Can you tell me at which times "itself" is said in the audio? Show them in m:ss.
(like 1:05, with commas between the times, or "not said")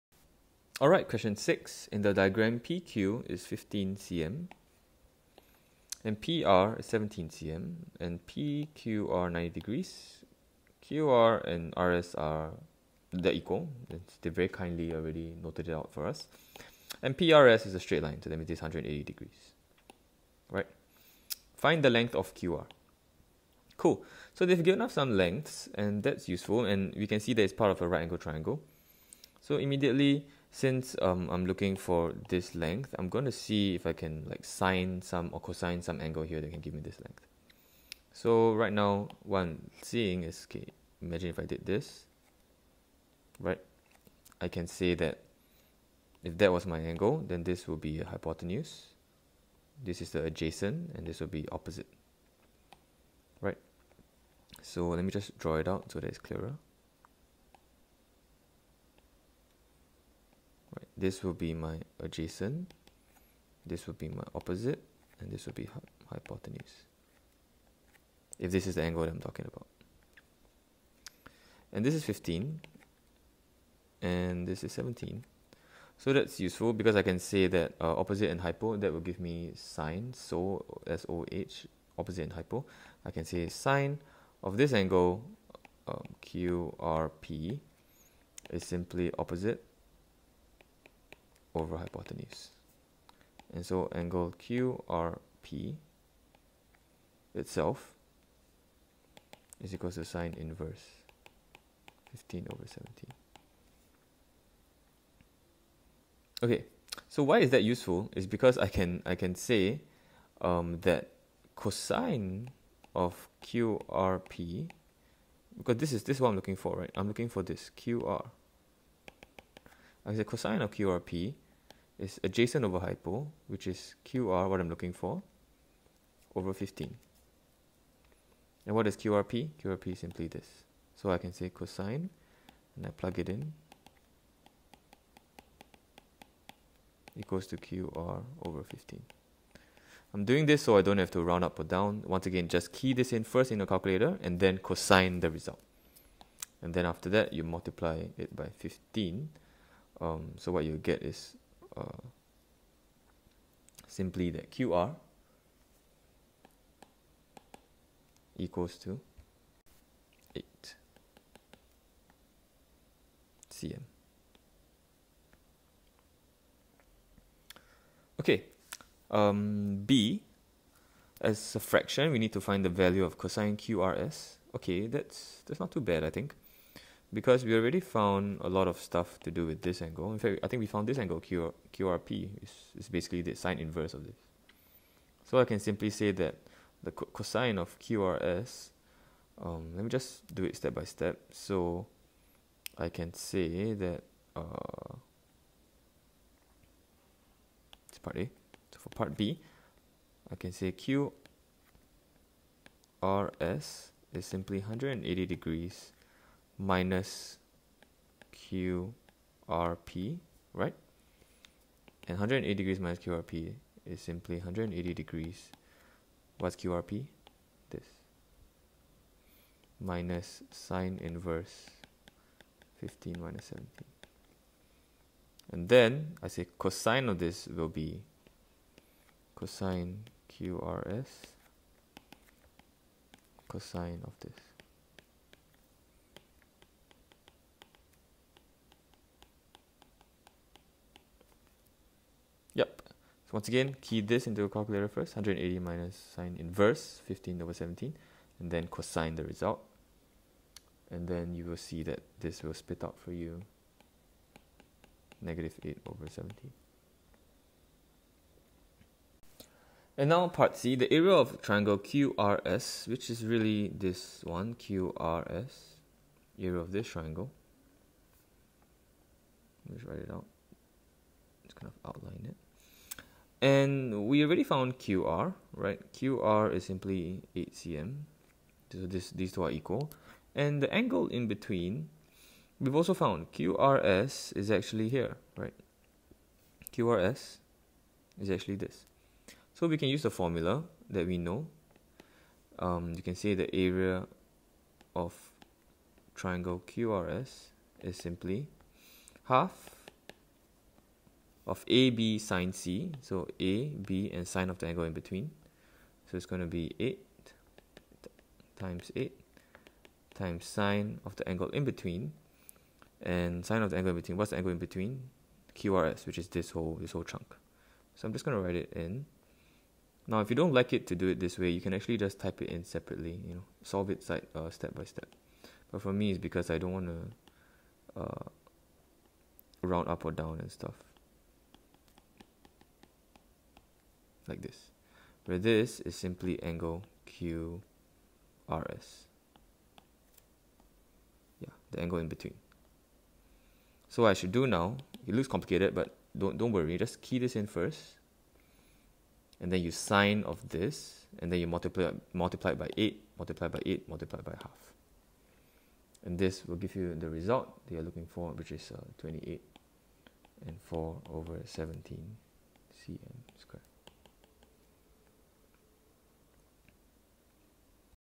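1:37.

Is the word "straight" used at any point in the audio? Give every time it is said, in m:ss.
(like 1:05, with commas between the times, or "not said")
0:17.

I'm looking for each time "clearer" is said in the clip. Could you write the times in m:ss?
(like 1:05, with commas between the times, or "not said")
0:56.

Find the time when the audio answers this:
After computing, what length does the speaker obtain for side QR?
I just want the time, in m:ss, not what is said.
2:34.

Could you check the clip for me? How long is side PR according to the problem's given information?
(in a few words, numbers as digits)
17 cm.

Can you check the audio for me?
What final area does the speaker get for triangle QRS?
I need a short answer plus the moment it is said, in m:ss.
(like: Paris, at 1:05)
28 4/17 cm squared, at 5:58.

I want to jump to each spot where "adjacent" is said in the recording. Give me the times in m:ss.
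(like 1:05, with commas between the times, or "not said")
0:50, 1:01, 2:02.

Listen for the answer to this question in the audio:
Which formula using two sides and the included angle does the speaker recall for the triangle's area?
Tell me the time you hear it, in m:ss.
4:59.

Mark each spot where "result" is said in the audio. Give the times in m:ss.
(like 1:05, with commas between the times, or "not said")
2:25, 4:09, 5:57.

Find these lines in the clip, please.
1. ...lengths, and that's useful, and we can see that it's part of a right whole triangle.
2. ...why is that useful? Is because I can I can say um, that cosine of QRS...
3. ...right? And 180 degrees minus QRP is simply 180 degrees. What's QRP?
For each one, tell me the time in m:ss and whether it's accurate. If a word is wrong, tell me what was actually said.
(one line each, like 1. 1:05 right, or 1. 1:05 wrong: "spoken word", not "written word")
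1. 0:25 wrong: "angle", not "whole"
2. 1:47 wrong: "QRP", not "QRS"
3. 3:30 right.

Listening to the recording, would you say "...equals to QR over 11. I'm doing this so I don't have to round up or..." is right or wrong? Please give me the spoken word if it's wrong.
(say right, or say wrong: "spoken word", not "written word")
wrong: "15", not "11".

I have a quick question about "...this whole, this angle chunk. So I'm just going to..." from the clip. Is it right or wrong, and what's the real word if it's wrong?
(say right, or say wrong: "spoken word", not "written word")
wrong: "whole", not "angle".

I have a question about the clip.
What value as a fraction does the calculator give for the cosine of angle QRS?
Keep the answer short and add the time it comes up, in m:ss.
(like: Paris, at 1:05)
-8/17, at 4:15.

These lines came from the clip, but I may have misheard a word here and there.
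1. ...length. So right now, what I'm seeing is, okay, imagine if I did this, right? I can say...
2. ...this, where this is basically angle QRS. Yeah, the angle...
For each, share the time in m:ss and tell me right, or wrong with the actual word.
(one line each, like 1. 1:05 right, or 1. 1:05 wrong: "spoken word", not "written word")
1. 0:36 right
2. 5:34 wrong: "simply", not "basically".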